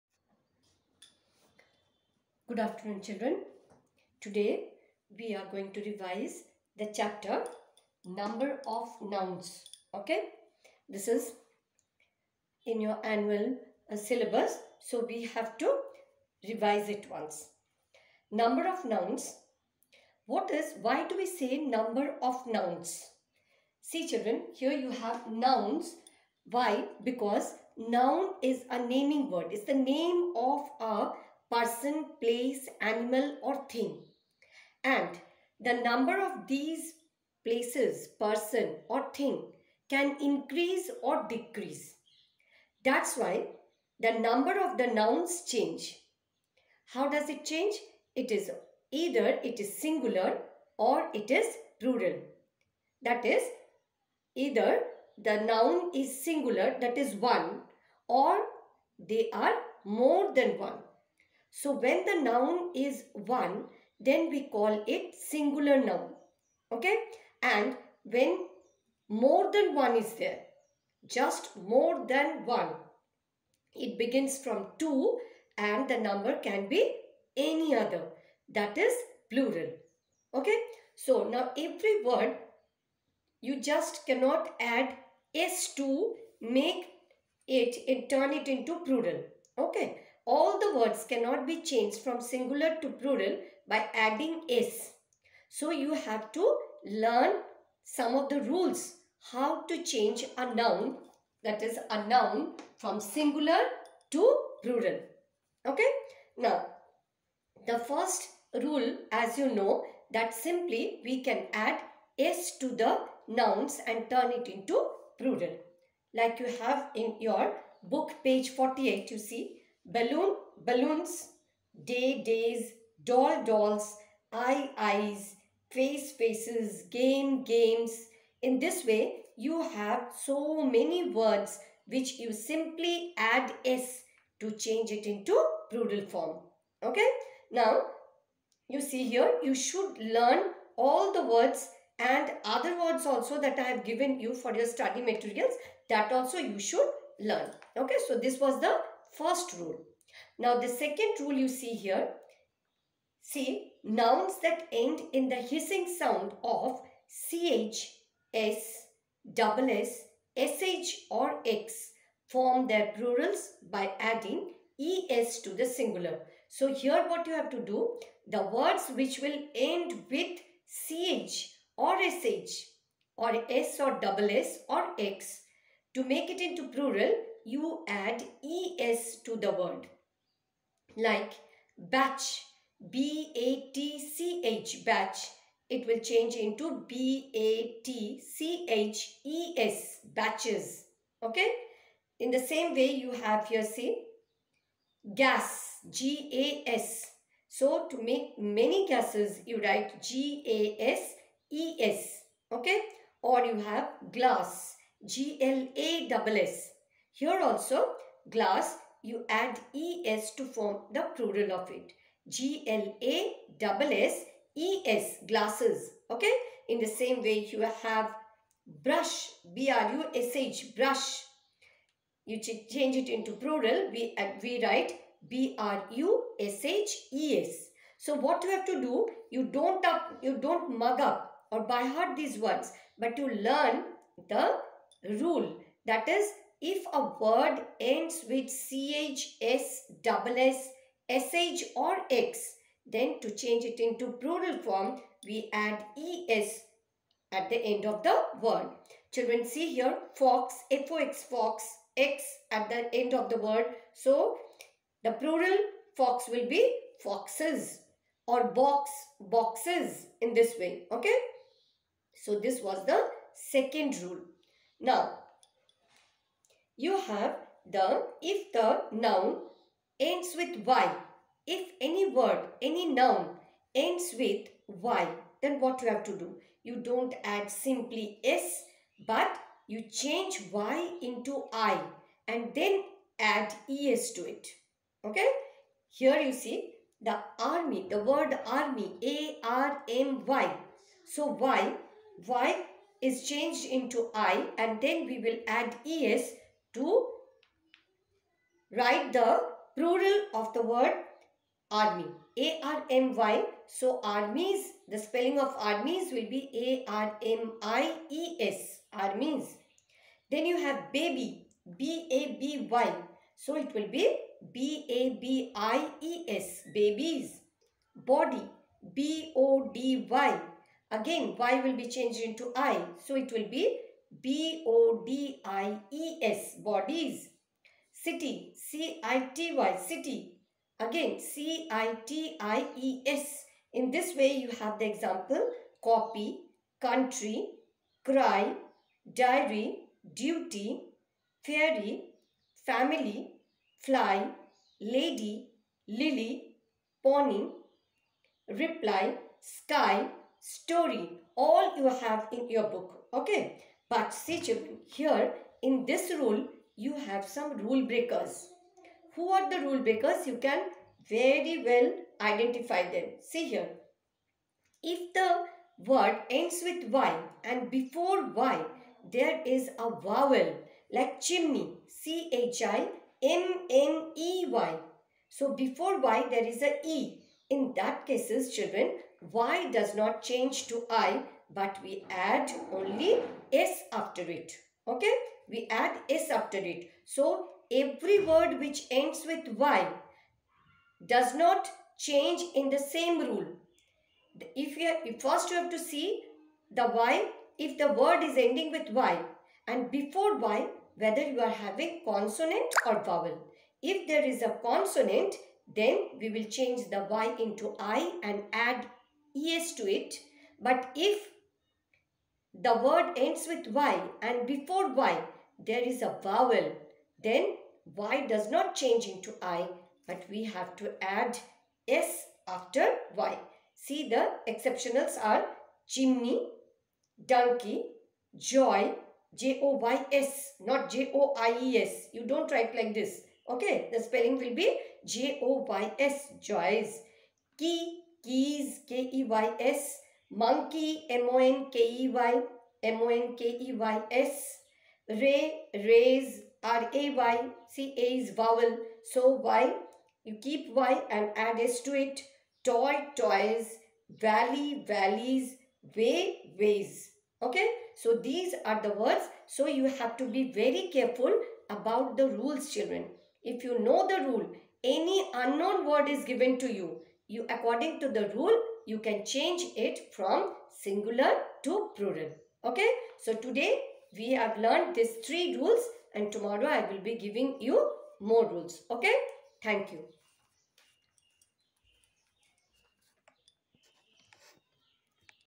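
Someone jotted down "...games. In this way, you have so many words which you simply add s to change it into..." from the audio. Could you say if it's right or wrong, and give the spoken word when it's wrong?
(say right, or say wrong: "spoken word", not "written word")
right.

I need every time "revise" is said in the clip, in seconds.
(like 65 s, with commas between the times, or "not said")
5 s, 16 s.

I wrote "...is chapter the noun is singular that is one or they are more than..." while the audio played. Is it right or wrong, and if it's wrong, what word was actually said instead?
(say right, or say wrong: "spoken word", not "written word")
wrong: "either", not "chapter".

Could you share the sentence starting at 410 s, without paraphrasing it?
But if the word ends with Y and before Y there is a vowel.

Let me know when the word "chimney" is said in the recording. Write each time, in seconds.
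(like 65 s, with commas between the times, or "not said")
371 s, 425 s.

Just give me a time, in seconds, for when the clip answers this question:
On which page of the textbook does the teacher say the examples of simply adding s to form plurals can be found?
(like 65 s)
118 s.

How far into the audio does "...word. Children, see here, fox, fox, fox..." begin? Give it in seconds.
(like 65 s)
248 s.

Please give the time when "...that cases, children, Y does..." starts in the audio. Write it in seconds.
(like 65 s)
377 s.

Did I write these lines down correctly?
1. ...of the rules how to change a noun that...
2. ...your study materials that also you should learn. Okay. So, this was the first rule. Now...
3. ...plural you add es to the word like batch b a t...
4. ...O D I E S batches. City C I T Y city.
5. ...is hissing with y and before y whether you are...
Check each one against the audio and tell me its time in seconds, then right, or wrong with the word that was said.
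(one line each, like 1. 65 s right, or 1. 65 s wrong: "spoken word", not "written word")
1. 98 s right
2. 144 s right
3. 176 s right
4. 324 s wrong: "bodies", not "batches"
5. 398 s wrong: "ending", not "hissing".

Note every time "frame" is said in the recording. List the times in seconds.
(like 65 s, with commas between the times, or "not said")
not said.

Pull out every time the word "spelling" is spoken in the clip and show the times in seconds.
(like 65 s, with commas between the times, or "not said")
304 s, 434 s.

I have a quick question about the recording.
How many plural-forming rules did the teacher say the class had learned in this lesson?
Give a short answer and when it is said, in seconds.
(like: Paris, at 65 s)
3, at 475 s.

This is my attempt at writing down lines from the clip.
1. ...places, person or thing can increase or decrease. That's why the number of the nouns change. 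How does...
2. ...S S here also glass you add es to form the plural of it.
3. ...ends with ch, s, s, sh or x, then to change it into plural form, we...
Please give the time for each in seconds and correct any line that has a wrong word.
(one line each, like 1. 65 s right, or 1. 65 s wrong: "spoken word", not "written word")
1. 37 s right
2. 206 s right
3. 237 s right.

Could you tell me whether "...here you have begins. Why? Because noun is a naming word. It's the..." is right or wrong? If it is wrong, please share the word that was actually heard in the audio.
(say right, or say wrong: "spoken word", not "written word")
wrong: "nouns", not "begins".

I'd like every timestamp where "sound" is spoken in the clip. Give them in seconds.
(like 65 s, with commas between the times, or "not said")
155 s.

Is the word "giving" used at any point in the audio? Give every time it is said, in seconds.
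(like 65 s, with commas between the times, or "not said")
477 s.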